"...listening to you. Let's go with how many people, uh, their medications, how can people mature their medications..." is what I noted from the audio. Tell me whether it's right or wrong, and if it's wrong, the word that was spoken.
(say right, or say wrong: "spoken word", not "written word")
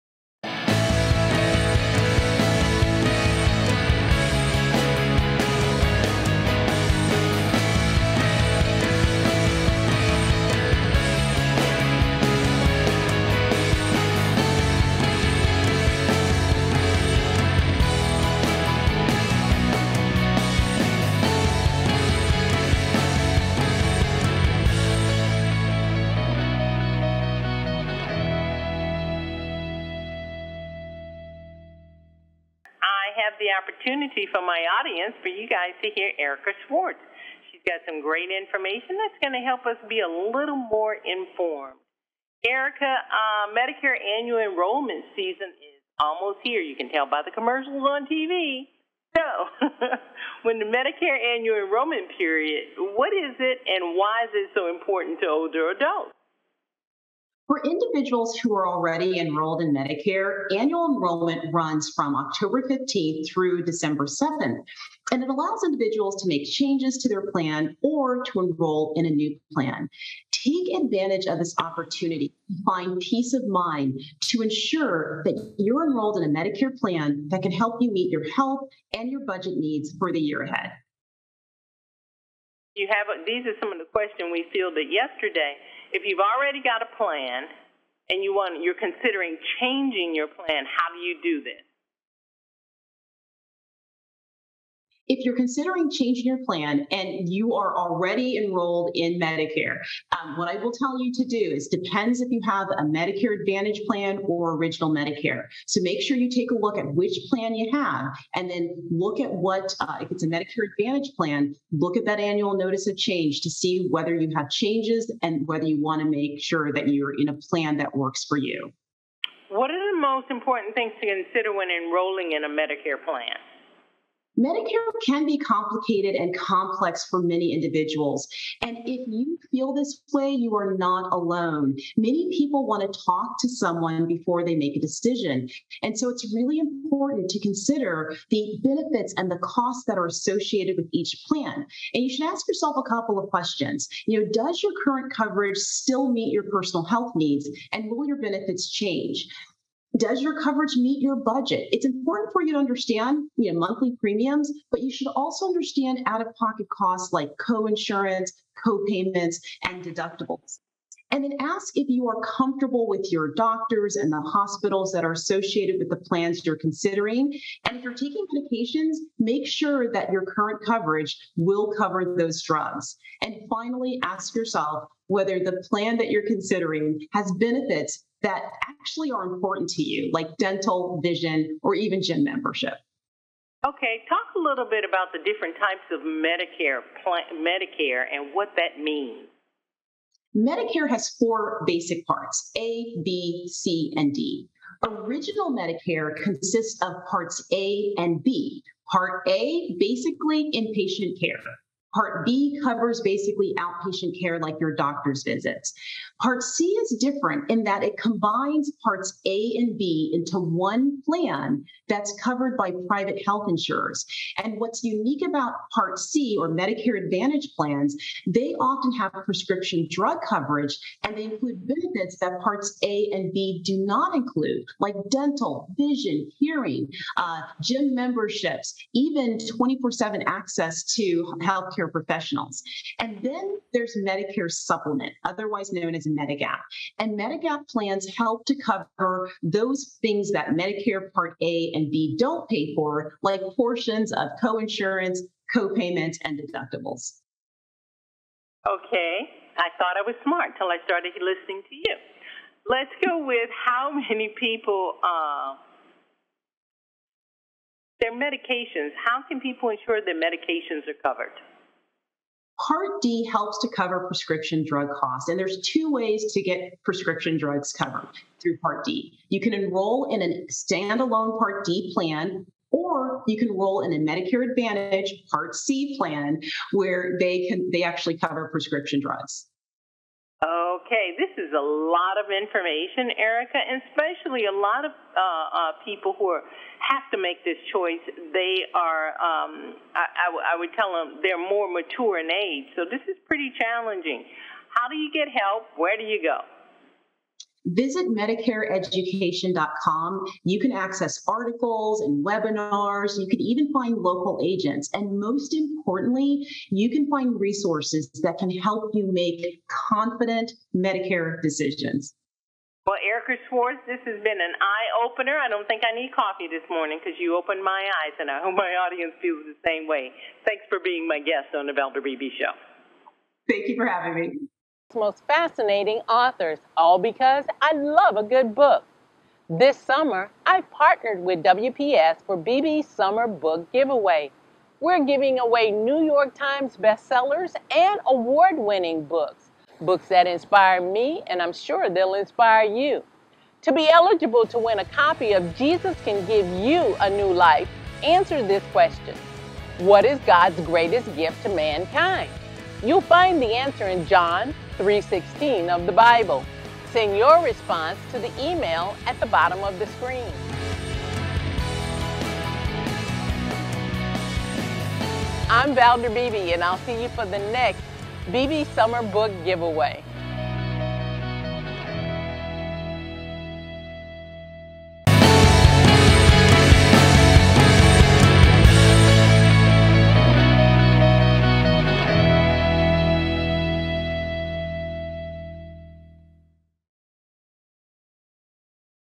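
wrong: "ensure", not "mature".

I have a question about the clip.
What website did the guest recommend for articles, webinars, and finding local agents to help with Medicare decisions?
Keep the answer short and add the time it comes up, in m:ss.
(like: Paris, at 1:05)
MedicareEducation.com, at 4:58.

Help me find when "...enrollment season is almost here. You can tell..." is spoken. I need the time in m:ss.
0:44.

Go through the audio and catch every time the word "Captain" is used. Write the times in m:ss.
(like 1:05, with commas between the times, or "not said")
not said.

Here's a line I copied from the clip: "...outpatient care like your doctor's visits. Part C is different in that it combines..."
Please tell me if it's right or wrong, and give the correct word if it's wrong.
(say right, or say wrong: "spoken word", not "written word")
right.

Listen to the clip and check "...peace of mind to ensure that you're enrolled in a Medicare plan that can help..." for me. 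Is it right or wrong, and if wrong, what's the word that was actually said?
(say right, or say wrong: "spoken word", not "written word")
right.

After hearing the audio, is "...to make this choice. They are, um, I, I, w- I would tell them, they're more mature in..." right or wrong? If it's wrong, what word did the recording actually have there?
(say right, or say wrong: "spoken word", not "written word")
right.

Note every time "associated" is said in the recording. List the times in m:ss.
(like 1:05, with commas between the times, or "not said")
2:20, 2:45.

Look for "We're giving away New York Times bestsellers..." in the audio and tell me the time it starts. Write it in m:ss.
5:34.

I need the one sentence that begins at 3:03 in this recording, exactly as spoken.
Okay, talk a little bit about the different types of Medicare, plan, Medicare, and what that means.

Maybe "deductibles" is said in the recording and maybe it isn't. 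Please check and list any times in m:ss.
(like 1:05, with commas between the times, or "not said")
2:39, 4:06.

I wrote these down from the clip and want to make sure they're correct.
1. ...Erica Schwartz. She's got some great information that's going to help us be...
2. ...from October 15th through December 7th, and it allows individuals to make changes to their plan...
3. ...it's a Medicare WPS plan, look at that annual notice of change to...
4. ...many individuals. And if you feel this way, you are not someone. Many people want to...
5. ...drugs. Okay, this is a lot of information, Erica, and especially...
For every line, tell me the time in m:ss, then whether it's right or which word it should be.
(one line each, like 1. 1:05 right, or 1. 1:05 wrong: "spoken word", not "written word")
1. 0:36 right
2. 1:01 right
3. 1:50 wrong: "Advantage", not "WPS"
4. 2:07 wrong: "alone", not "someone"
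5. 4:39 right.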